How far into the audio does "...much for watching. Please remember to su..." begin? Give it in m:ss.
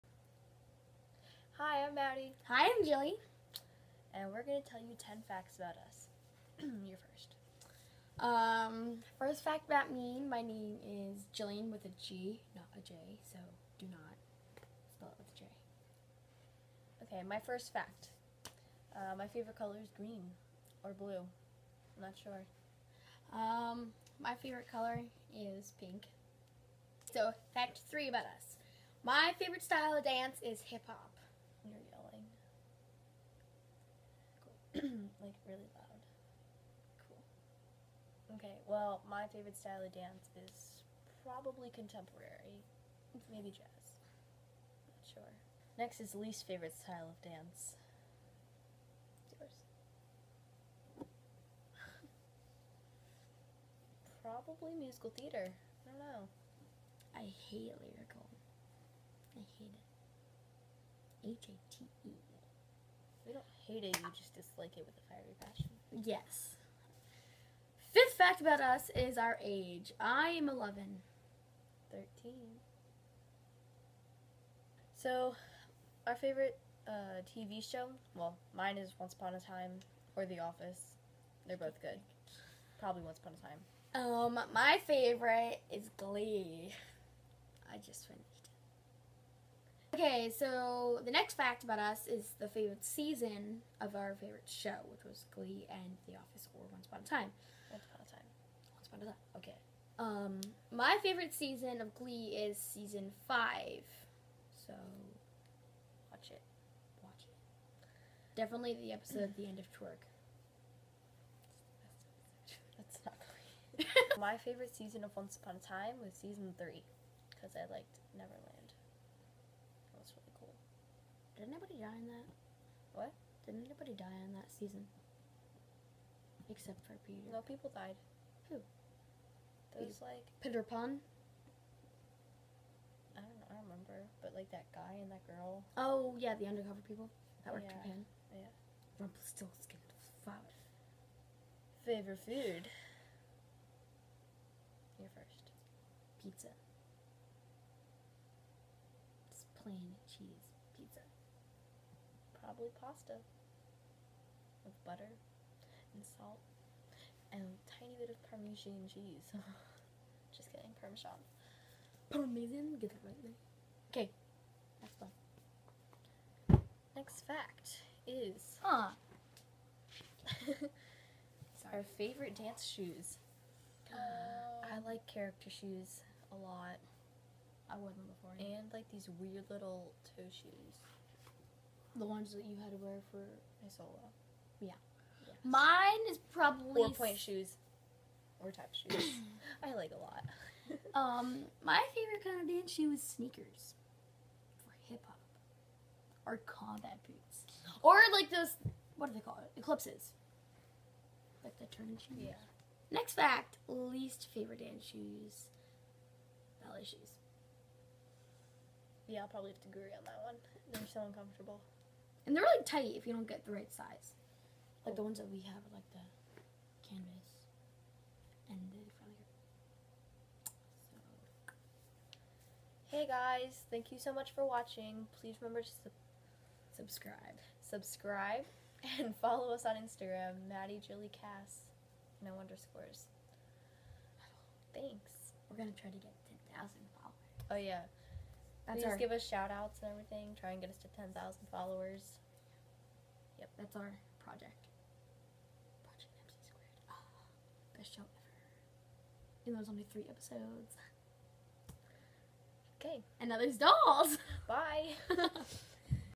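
3:44.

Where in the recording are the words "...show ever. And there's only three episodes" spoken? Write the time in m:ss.
4:07.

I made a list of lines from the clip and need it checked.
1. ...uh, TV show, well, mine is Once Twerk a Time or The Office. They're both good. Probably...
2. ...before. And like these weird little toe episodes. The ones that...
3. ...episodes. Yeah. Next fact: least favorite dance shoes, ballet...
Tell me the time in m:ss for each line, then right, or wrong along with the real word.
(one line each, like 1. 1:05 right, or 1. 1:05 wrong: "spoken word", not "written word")
1. 1:16 wrong: "Upon", not "Twerk"
2. 2:58 wrong: "shoes", not "episodes"
3. 3:21 wrong: "shoes", not "episodes".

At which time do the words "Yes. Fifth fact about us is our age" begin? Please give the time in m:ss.
1:06.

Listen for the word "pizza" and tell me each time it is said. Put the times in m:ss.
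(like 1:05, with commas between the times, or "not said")
2:26, 2:30.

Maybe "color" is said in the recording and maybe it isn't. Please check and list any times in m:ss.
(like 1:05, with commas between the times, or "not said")
0:19, 0:24.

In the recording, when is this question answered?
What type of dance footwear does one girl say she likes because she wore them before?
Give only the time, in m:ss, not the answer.
2:55.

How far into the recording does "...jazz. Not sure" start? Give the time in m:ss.
0:43.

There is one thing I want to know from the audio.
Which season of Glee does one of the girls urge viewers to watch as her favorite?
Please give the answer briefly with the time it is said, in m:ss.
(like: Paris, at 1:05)
Season 5, at 1:42.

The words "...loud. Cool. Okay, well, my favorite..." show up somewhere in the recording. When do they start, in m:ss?
0:35.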